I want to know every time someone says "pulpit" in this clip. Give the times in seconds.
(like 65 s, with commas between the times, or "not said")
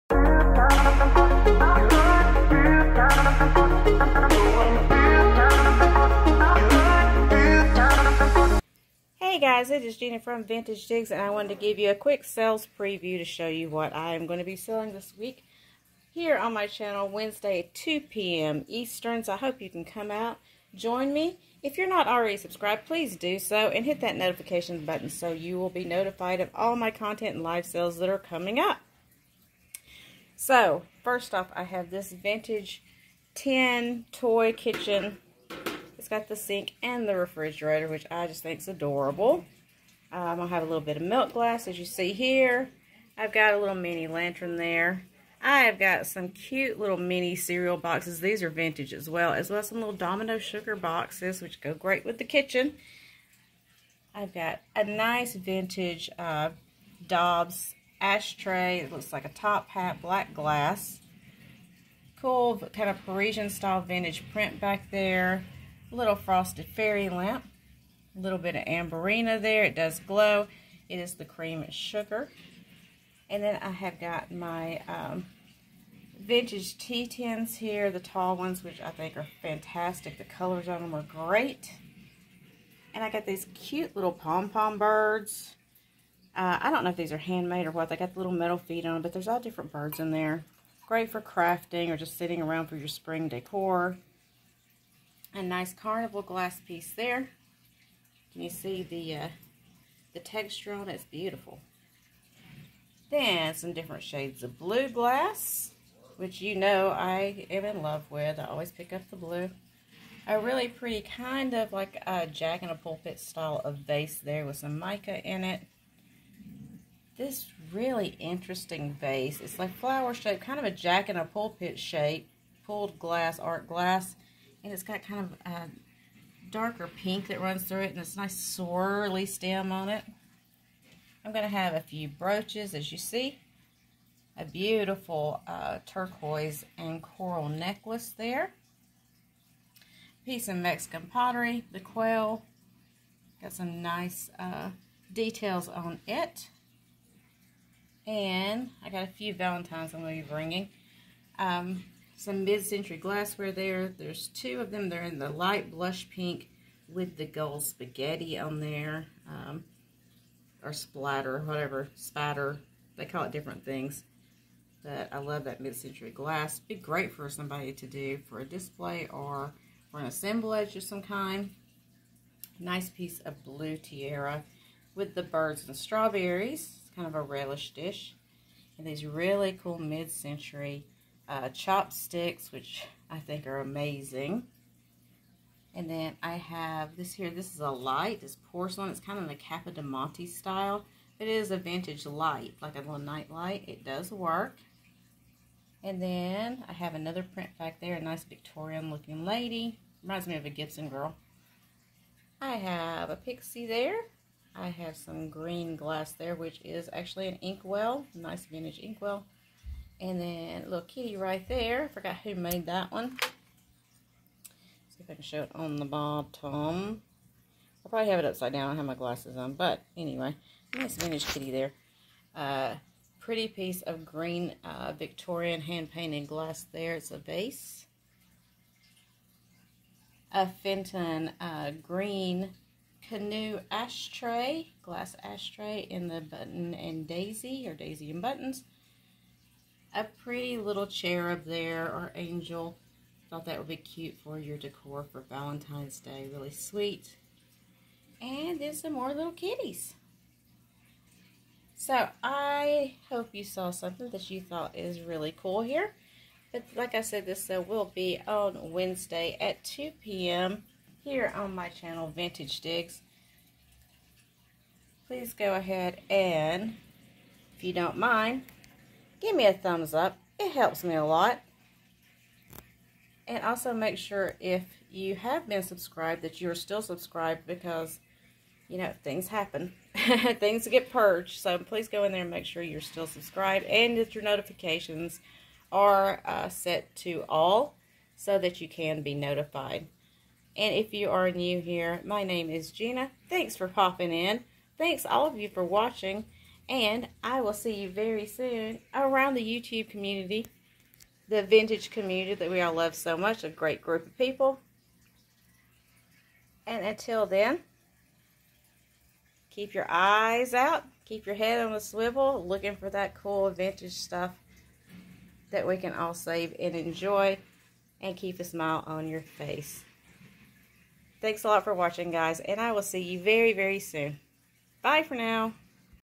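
112 s, 121 s.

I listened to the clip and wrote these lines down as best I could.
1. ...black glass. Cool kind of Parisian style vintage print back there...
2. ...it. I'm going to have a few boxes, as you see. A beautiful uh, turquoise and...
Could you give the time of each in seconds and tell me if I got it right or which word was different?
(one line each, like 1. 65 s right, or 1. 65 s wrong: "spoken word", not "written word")
1. 60 s right
2. 129 s wrong: "brooches", not "boxes".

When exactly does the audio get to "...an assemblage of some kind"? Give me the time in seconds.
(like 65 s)
169 s.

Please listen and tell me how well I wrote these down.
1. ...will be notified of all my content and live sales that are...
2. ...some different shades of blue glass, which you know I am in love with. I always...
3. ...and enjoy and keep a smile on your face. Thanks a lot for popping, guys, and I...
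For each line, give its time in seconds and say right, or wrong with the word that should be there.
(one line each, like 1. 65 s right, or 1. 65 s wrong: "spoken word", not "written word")
1. 25 s right
2. 103 s right
3. 316 s wrong: "watching", not "popping".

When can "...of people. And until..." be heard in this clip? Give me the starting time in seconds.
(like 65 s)
304 s.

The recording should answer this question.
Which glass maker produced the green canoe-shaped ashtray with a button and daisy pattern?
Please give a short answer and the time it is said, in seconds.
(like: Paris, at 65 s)
Fenton, at 230 s.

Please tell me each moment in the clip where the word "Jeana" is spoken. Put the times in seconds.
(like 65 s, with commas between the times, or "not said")
9 s, 292 s.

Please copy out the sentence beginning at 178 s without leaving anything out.
And these really cool mid-century uh, chopsticks, which I think are amazing.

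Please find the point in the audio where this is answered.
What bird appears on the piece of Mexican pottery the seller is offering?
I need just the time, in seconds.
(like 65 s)
141 s.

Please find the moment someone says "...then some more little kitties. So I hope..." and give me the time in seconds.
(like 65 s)
248 s.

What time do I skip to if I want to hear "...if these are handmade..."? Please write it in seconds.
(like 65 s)
86 s.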